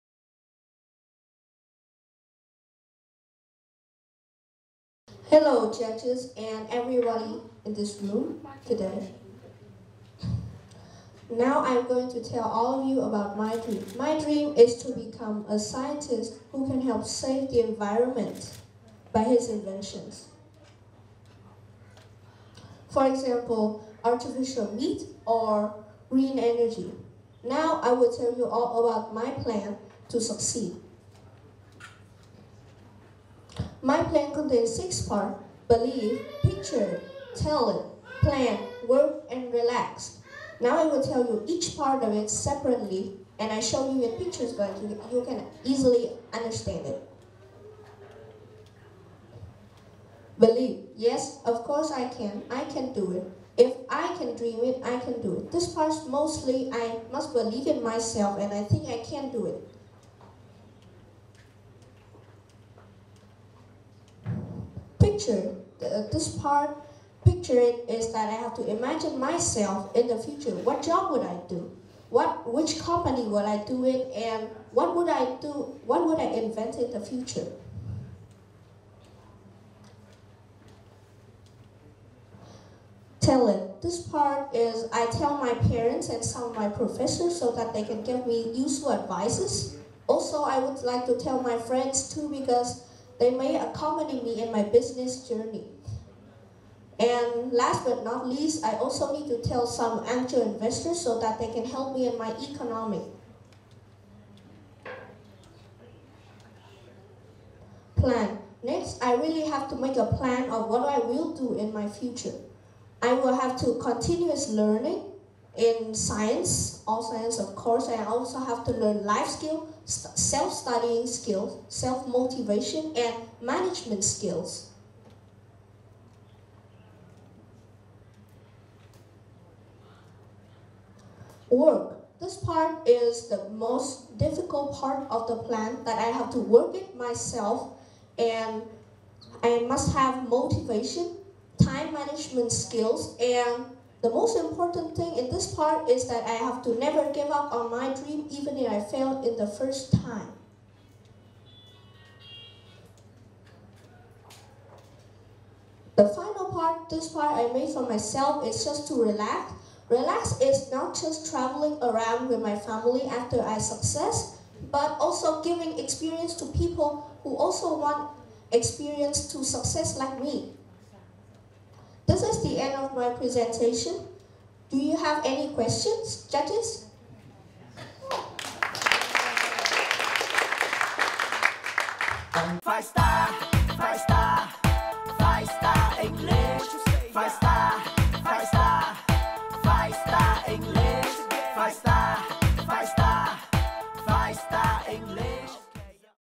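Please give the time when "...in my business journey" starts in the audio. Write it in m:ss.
1:34.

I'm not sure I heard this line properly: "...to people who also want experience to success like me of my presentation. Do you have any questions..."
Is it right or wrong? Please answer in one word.
right.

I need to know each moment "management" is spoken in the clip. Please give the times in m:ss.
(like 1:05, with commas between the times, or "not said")
2:03, 2:21.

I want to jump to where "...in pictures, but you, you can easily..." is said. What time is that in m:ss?
0:44.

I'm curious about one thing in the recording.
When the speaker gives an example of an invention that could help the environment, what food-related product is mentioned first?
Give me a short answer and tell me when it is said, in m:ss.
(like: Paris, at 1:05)
artificial meat, at 0:24.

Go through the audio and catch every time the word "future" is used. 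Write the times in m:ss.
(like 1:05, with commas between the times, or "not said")
1:05, 1:10, 1:16, 1:51.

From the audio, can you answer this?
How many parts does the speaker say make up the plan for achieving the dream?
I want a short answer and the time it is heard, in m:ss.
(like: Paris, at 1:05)
6, at 0:34.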